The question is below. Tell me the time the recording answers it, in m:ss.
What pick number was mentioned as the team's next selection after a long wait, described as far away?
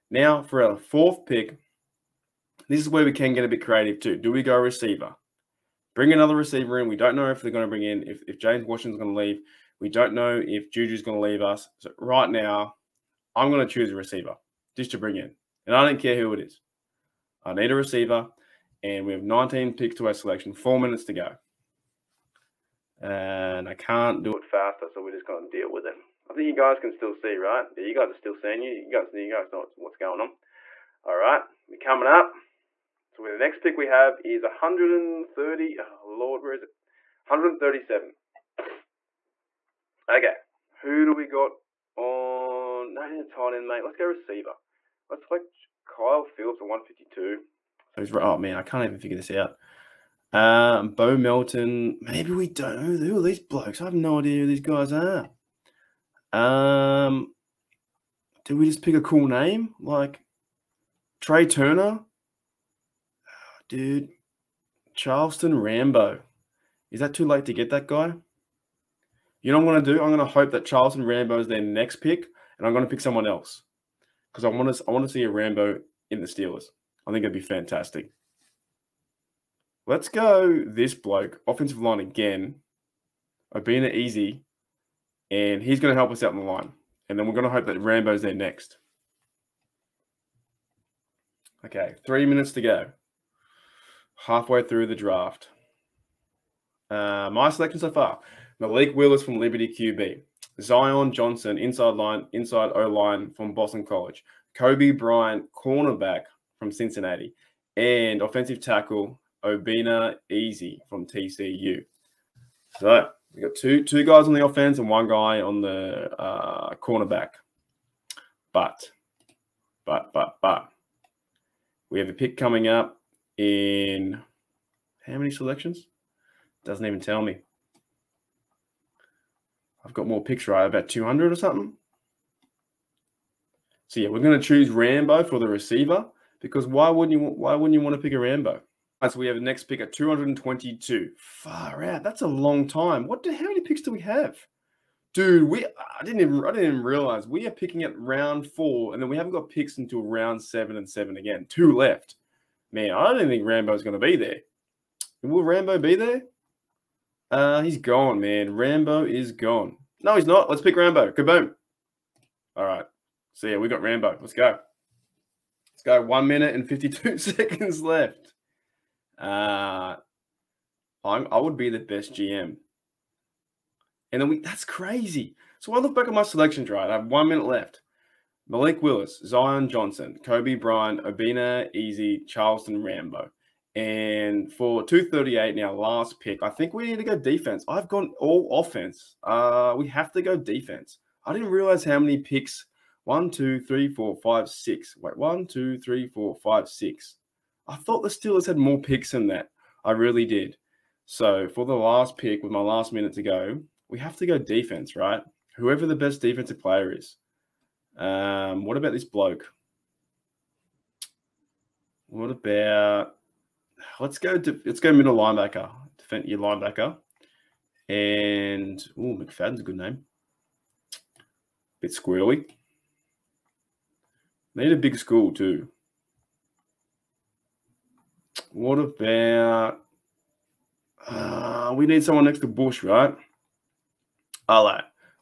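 2:19.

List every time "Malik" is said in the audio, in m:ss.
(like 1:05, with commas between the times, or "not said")
1:38, 2:58.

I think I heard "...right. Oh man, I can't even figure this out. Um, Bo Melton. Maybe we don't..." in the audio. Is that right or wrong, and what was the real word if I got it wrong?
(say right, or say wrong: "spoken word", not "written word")
right.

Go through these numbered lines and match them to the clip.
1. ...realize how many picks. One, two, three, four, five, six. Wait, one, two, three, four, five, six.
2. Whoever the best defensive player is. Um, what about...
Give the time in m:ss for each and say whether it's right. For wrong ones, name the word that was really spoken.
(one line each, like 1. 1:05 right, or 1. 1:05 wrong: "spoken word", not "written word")
1. 3:11 right
2. 3:25 right.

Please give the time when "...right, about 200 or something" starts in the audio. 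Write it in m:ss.
2:10.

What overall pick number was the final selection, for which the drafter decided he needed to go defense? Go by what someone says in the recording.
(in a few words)
238.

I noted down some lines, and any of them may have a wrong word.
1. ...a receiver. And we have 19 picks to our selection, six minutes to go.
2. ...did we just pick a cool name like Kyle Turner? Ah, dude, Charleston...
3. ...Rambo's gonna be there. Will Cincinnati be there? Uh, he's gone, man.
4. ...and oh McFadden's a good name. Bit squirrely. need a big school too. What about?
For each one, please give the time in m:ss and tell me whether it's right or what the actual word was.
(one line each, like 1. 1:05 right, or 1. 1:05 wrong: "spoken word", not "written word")
1. 0:17 wrong: "four", not "six"
2. 0:58 wrong: "Trey", not "Kyle"
3. 2:33 wrong: "Rambo", not "Cincinnati"
4. 3:37 right.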